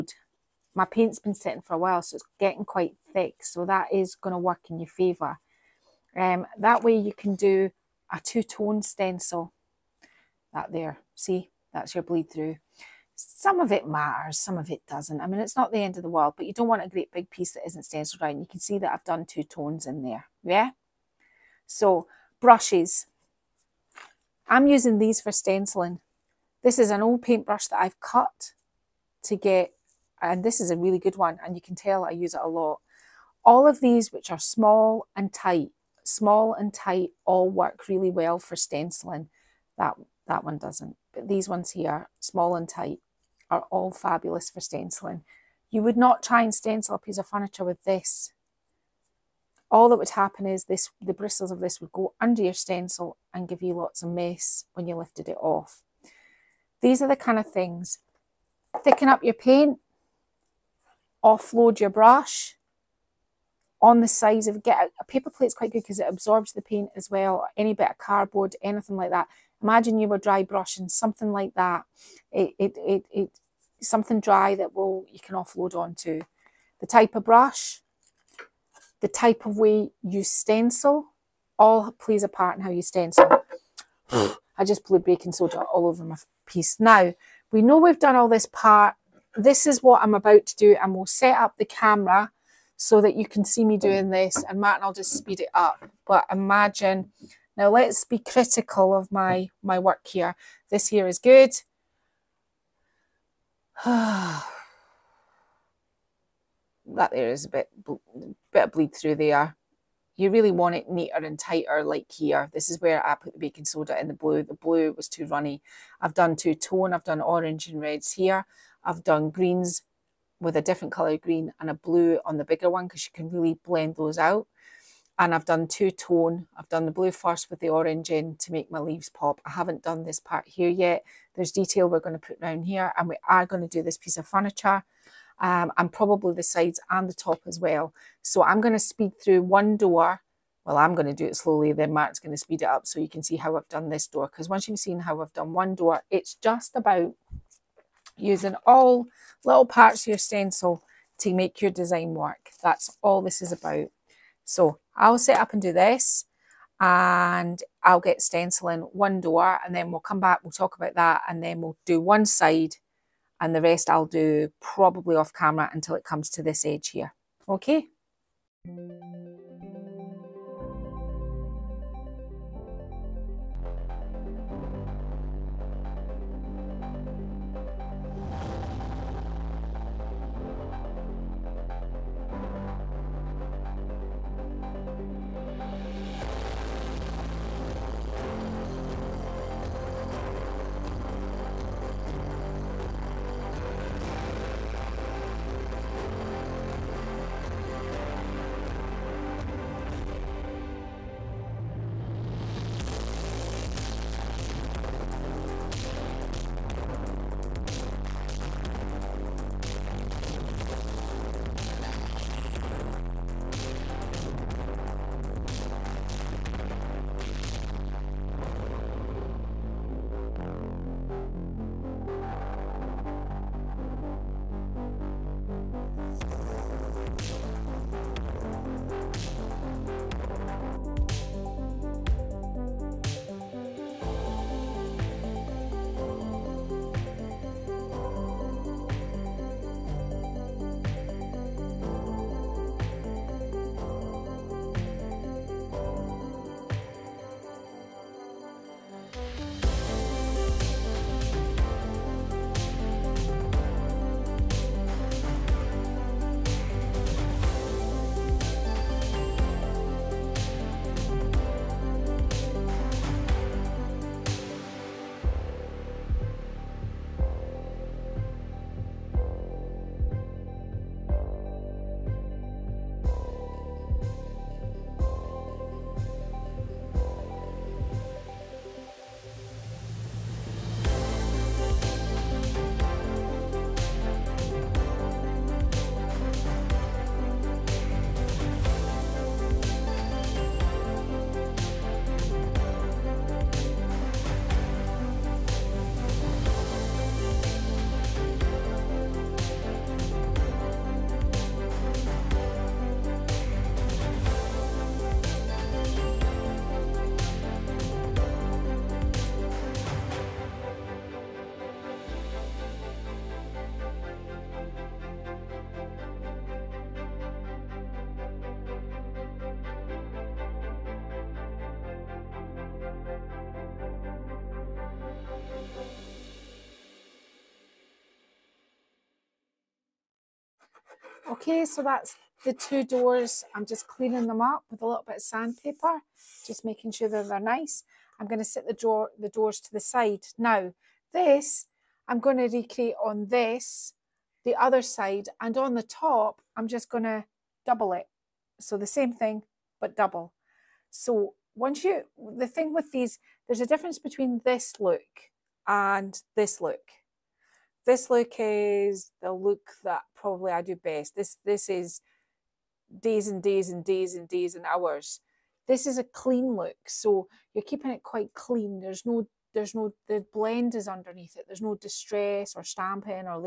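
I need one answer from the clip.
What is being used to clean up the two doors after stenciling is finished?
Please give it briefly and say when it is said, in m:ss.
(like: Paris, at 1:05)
Sandpaper, at 5:35.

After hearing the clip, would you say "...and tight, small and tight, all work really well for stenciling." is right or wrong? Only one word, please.
right.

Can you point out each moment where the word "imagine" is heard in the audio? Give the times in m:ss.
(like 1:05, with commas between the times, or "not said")
1:09, 1:36.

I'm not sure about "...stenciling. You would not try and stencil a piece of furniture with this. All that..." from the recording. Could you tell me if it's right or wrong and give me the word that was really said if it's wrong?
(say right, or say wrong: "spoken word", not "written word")
right.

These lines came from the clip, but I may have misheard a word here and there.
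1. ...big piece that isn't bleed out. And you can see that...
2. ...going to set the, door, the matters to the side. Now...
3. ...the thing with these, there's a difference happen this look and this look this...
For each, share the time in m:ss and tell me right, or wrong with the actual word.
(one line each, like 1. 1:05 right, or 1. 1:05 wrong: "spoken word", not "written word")
1. 0:17 wrong: "stenciled", not "bleed"
2. 5:38 wrong: "doors", not "matters"
3. 5:52 wrong: "between", not "happen".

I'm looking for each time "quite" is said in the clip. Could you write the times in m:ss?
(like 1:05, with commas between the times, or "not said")
0:02, 1:05, 6:08.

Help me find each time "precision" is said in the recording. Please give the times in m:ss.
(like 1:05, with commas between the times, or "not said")
not said.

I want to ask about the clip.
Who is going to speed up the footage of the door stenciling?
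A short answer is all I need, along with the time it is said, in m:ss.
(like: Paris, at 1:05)
Mark, at 2:21.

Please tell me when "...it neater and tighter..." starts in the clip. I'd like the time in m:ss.
1:50.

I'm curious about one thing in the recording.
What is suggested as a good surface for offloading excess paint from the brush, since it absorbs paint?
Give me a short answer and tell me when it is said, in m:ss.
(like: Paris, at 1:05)
Paper plate, at 1:05.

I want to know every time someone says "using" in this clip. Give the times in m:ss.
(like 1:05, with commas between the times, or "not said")
0:24, 2:28.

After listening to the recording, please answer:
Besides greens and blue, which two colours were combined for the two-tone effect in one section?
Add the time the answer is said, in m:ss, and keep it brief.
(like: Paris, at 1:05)
Orange and reds, at 1:57.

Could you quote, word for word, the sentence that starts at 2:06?
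I've done the blue first with the orange in to make my leaves pop.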